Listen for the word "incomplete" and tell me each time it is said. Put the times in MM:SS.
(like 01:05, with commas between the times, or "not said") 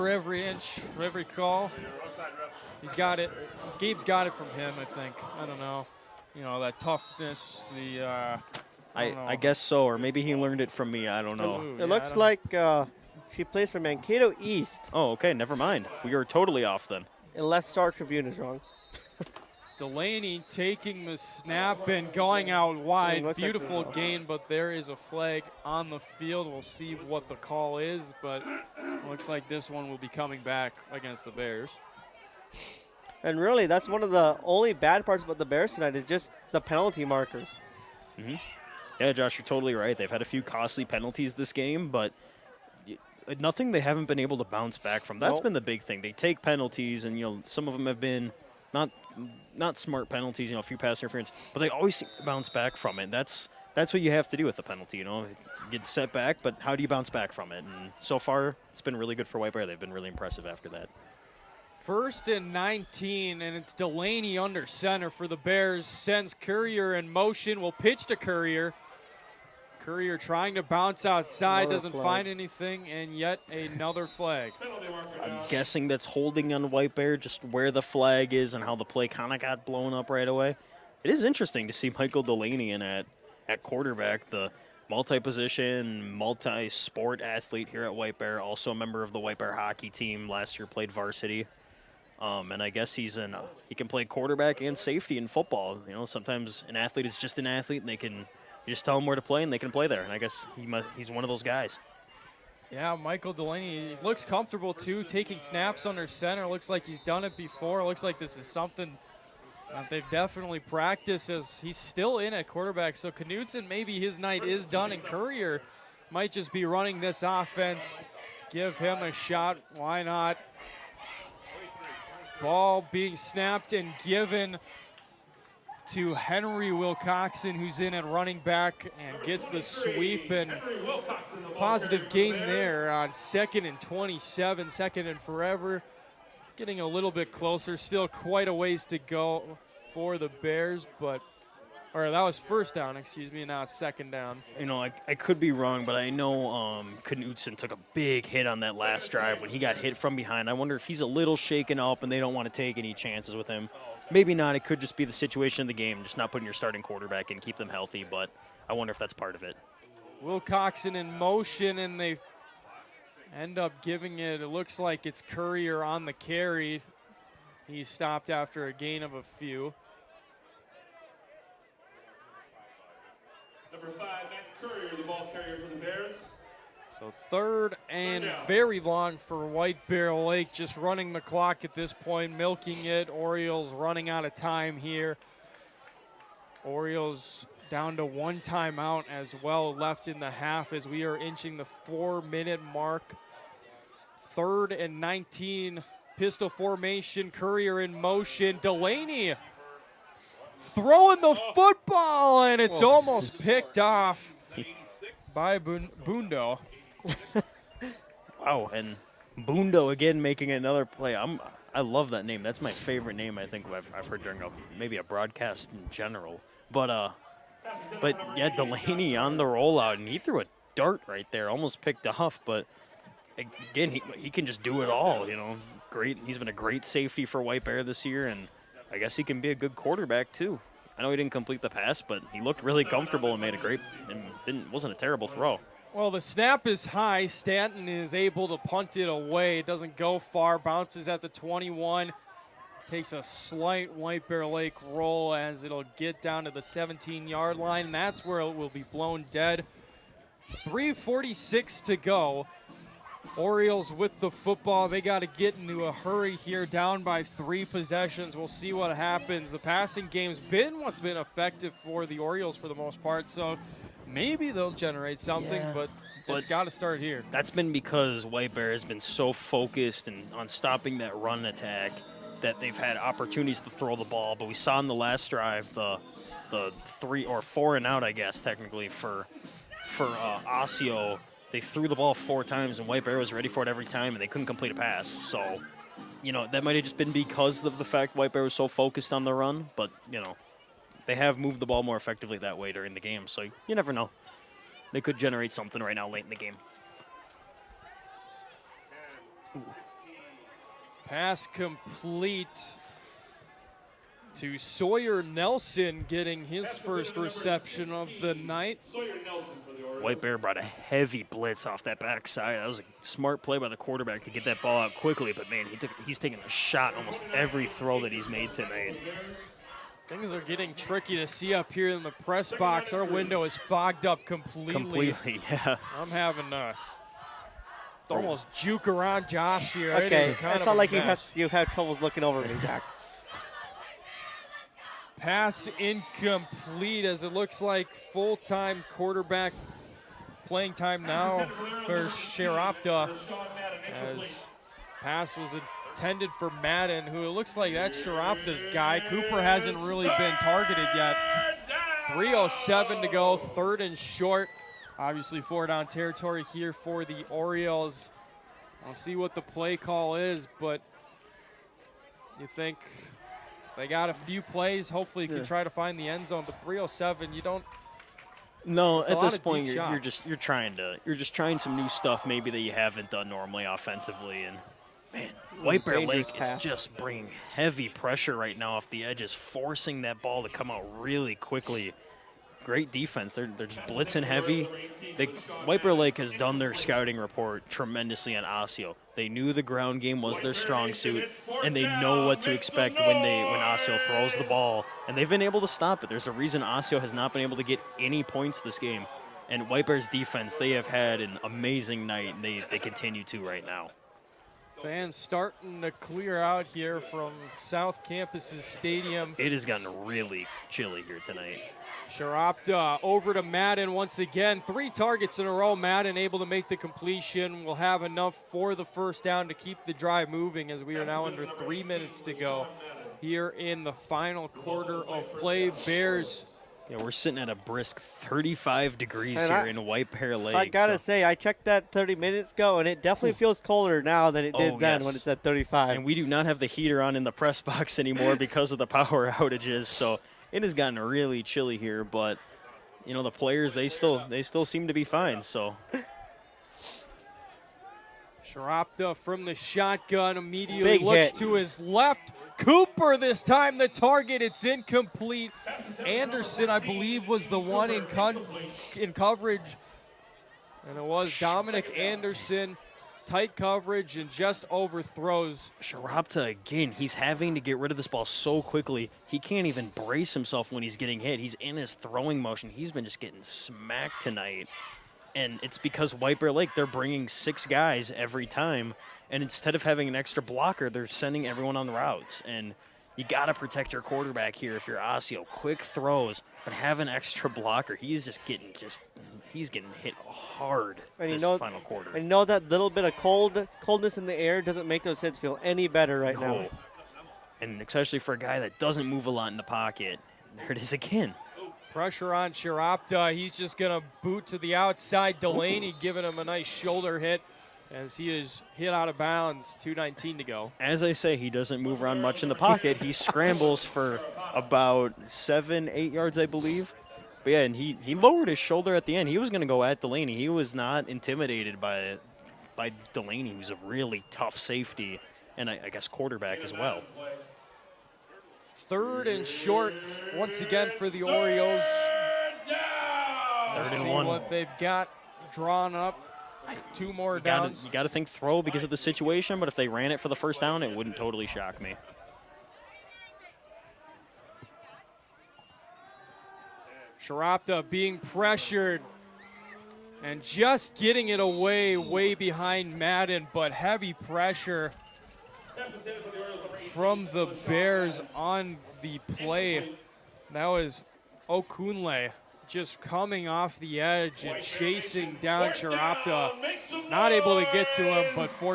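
05:35, 07:34.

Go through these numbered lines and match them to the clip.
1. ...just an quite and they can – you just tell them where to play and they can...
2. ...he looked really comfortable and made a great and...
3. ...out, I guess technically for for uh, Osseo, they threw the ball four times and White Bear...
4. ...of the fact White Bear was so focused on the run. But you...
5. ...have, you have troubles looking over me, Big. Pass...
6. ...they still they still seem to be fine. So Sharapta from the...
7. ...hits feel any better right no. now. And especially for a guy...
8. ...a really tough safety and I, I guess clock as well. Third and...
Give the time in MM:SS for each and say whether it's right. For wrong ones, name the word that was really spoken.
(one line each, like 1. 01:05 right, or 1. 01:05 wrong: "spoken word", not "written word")
1. 01:37 wrong: "athlete", not "quite"
2. 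03:52 right
3. 04:37 right
4. 04:47 right
5. 05:30 wrong: "Jack", not "Big"
6. 07:23 right
7. 08:15 right
8. 08:43 wrong: "quarterback", not "clock".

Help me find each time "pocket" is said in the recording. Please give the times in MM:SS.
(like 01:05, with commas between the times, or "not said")
08:19, 08:32.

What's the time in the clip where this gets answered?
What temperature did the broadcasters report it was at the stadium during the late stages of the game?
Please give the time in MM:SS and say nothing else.
07:08.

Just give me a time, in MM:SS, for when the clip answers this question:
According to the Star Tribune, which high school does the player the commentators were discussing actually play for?
00:13.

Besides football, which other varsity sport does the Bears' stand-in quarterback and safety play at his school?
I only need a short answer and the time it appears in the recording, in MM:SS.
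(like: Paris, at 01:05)
Hockey, at 01:29.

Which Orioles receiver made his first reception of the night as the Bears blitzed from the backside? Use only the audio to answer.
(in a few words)
Sawyer Nelson.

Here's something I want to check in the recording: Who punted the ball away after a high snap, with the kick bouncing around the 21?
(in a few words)
Stanton.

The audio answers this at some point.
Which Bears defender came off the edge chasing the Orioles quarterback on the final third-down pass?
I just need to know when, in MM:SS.
09:21.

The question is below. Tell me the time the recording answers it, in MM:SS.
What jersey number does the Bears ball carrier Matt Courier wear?
02:53.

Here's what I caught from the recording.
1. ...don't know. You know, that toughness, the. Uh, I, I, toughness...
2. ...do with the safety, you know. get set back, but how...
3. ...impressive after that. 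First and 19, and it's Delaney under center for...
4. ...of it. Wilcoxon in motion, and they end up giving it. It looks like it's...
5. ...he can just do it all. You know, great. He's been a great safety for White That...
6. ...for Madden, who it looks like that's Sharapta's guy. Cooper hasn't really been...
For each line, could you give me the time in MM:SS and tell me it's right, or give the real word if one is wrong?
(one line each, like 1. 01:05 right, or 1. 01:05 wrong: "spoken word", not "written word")
1. 00:05 wrong: "guess", not "toughness"
2. 00:54 wrong: "penalty", not "safety"
3. 01:00 right
4. 02:39 right
5. 03:44 wrong: "Bear", not "That"
6. 05:46 right.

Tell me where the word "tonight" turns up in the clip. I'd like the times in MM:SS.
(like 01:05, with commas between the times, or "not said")
00:35, 05:18, 06:51, 07:54.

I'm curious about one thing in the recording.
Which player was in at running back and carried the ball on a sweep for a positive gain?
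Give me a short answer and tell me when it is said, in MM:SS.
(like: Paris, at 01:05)
Henry Wilcoxon, at 02:06.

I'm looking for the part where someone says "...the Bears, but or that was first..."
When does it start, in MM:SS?
02:20.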